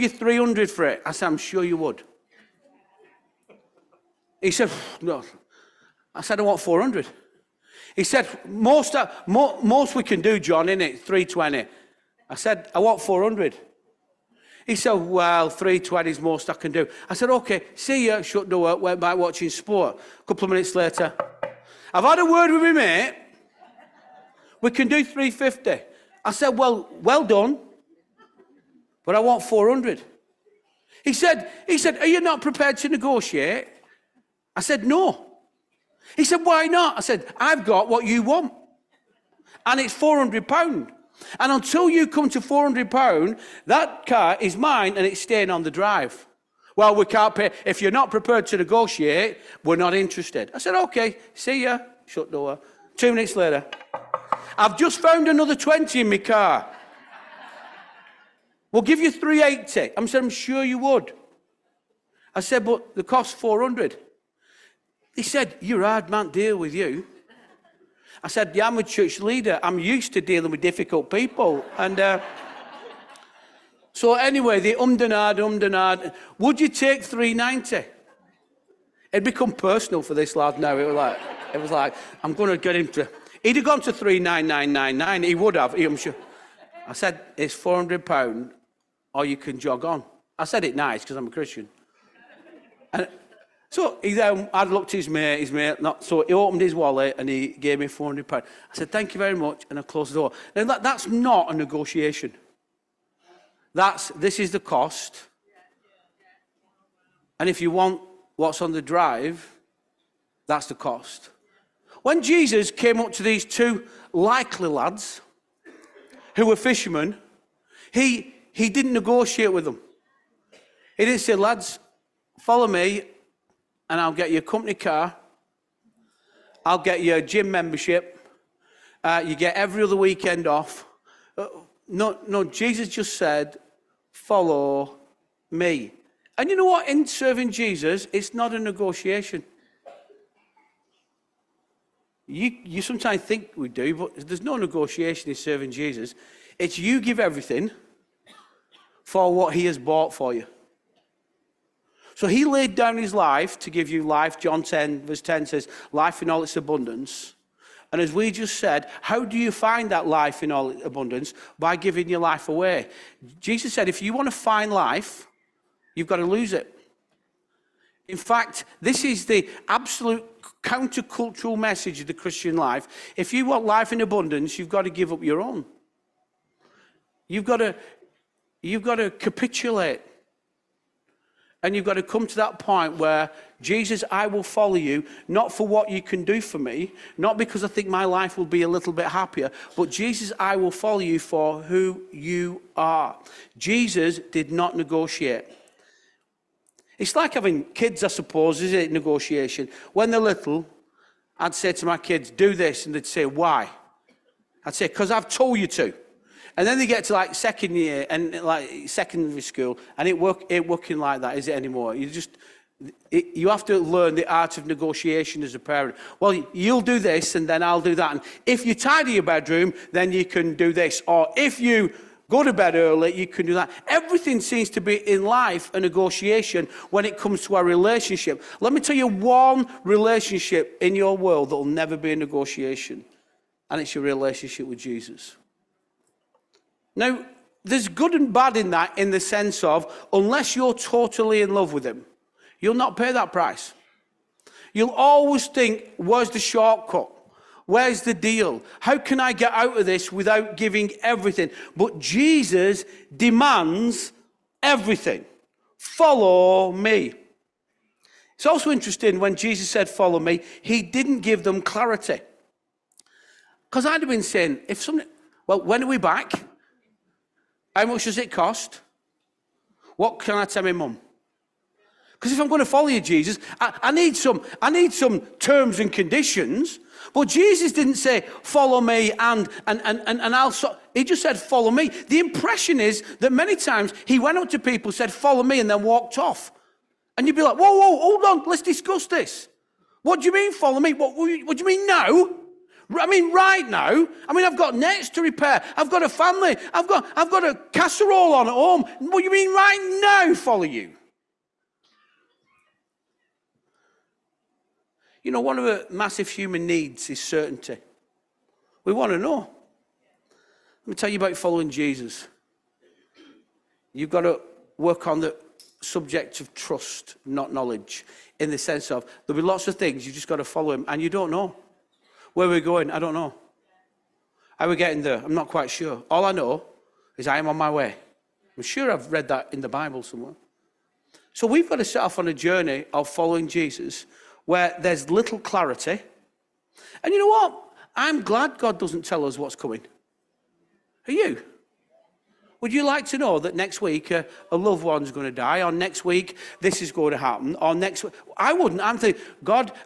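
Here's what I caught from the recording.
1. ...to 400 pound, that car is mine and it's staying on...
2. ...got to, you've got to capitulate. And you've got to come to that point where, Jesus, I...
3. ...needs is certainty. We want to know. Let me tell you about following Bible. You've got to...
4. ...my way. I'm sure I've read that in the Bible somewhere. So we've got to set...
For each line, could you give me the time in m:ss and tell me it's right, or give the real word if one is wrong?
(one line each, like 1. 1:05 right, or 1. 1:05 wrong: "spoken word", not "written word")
1. 0:42 right
2. 2:57 right
3. 5:06 wrong: "Jesus", not "Bible"
4. 5:27 right.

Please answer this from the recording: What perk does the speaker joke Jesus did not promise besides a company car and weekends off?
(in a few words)
Gym membership.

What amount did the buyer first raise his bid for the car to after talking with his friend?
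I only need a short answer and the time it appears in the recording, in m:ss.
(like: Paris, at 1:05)
350, at 0:25.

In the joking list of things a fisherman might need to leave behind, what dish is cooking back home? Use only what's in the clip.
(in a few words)
A casserole.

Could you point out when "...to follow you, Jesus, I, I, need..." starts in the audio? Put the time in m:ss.
4:32.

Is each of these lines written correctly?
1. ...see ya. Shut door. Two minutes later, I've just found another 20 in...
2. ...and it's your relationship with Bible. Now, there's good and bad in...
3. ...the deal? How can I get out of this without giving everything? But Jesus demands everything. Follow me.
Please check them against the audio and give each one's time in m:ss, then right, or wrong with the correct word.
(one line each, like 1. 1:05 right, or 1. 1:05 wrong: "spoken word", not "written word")
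1. 0:51 right
2. 3:53 wrong: "Jesus", not "Bible"
3. 4:08 right.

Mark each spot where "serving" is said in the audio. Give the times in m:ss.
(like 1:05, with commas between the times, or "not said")
2:17, 2:25.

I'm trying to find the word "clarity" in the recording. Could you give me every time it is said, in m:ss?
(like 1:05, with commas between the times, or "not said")
4:21, 5:35.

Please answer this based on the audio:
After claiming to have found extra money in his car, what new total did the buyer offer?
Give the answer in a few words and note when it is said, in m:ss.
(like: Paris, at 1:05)
380, at 0:59.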